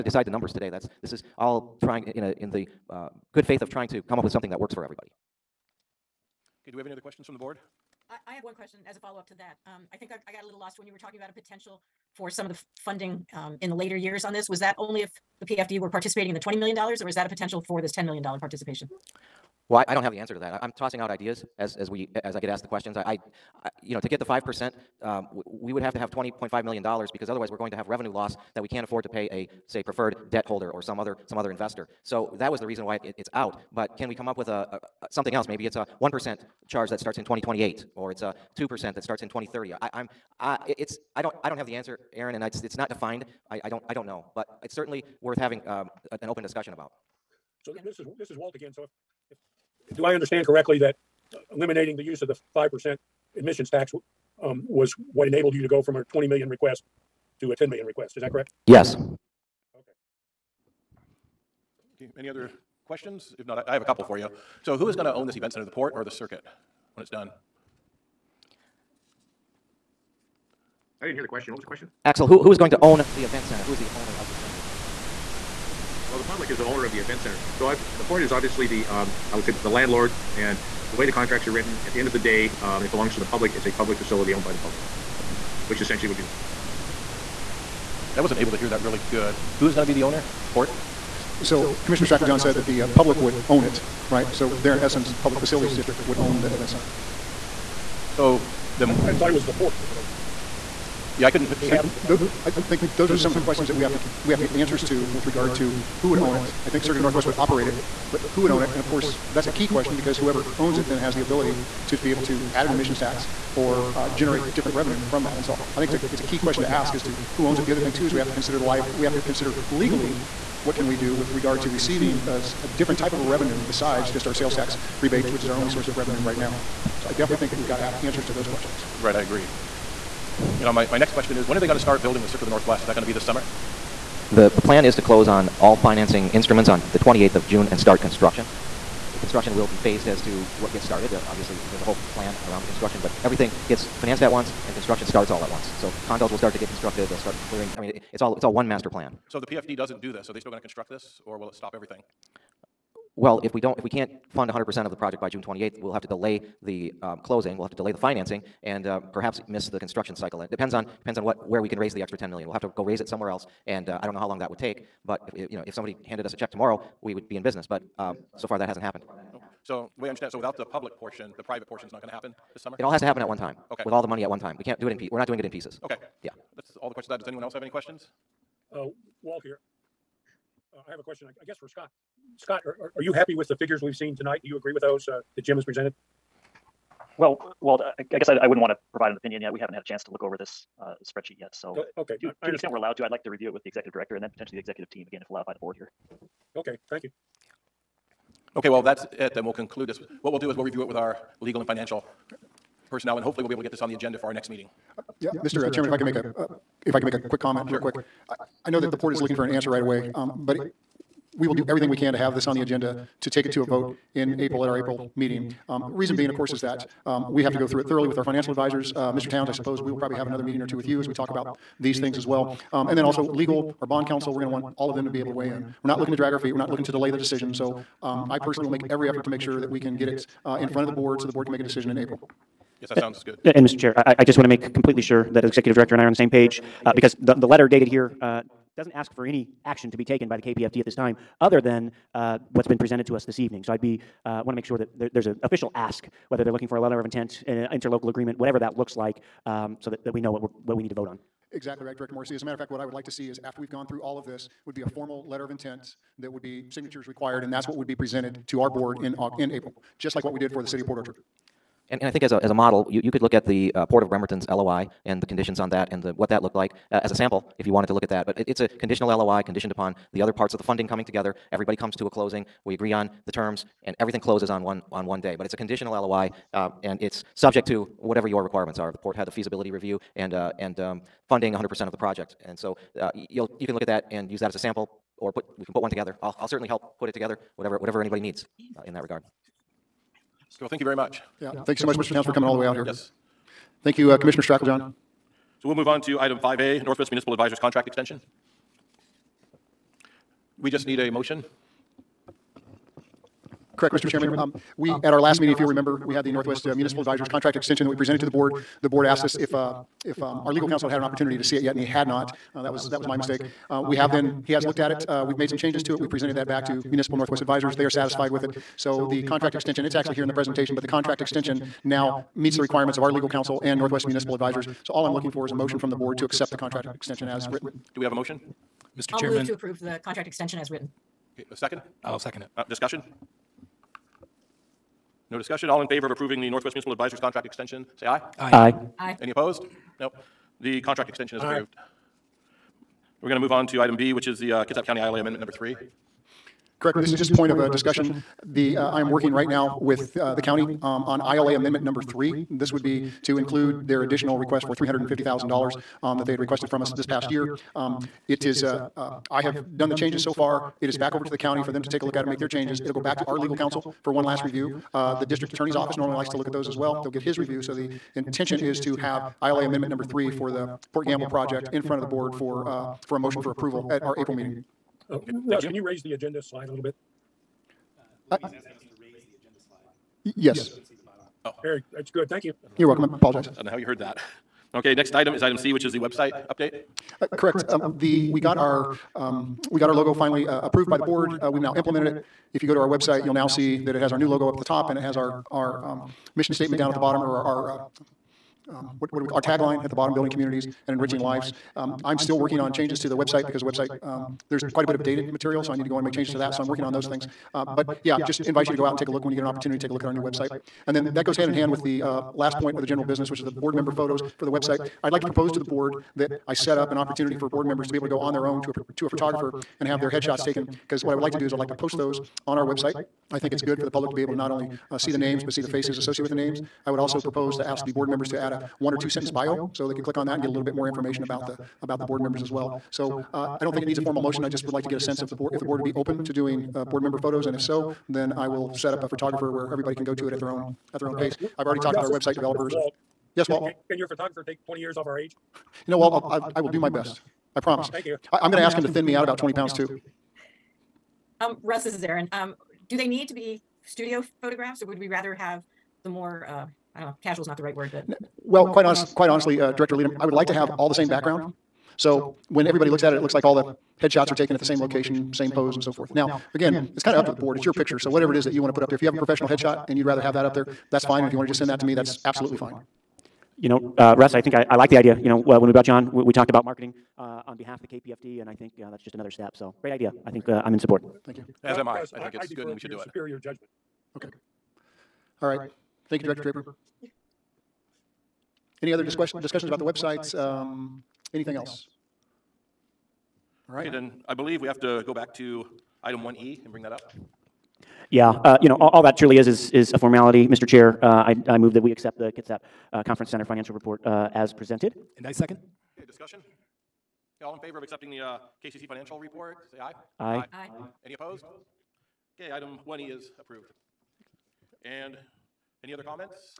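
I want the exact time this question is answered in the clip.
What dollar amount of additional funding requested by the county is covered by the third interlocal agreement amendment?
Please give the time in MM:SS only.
05:54.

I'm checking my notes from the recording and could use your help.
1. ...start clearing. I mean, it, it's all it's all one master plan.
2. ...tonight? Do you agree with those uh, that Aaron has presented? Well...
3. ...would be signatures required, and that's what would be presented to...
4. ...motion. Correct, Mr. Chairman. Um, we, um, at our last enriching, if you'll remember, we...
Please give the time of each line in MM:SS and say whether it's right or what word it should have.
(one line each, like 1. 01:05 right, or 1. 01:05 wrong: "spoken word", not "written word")
1. 02:27 right
2. 03:04 wrong: "Jim", not "Aaron"
3. 04:16 right
4. 05:01 wrong: "meeting", not "enriching".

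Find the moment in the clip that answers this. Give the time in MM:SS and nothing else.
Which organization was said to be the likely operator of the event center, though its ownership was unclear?
01:46.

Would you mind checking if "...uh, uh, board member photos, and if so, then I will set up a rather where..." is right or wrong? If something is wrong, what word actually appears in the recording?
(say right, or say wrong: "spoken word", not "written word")
wrong: "photographer", not "rather".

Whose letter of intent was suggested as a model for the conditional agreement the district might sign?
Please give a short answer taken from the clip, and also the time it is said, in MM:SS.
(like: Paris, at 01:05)
Port of Bremerton, at 04:23.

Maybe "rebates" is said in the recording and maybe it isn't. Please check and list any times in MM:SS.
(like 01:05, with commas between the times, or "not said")
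02:05.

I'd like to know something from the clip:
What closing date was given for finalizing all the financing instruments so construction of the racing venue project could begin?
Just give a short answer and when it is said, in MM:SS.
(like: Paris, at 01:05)
June 28, at 02:16.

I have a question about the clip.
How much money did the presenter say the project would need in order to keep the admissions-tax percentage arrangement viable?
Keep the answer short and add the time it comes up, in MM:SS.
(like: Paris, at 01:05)
$20.5 million, at 00:26.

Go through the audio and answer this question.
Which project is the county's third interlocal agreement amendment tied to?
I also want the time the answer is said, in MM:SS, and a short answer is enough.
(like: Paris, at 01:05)
Port Gamble, at 06:10.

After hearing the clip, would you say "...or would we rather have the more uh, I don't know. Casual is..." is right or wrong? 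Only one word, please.
right.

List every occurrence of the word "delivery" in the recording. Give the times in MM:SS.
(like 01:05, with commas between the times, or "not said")
not said.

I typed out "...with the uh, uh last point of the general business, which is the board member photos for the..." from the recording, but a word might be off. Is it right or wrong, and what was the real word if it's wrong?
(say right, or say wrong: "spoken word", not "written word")
right.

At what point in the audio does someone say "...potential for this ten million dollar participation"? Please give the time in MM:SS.
00:17.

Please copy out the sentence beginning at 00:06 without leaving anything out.
Okay, do we have any other questions from the board?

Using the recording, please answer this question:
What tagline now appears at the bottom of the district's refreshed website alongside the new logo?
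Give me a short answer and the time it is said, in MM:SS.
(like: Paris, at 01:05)
building communities and enriching lives, at 06:40.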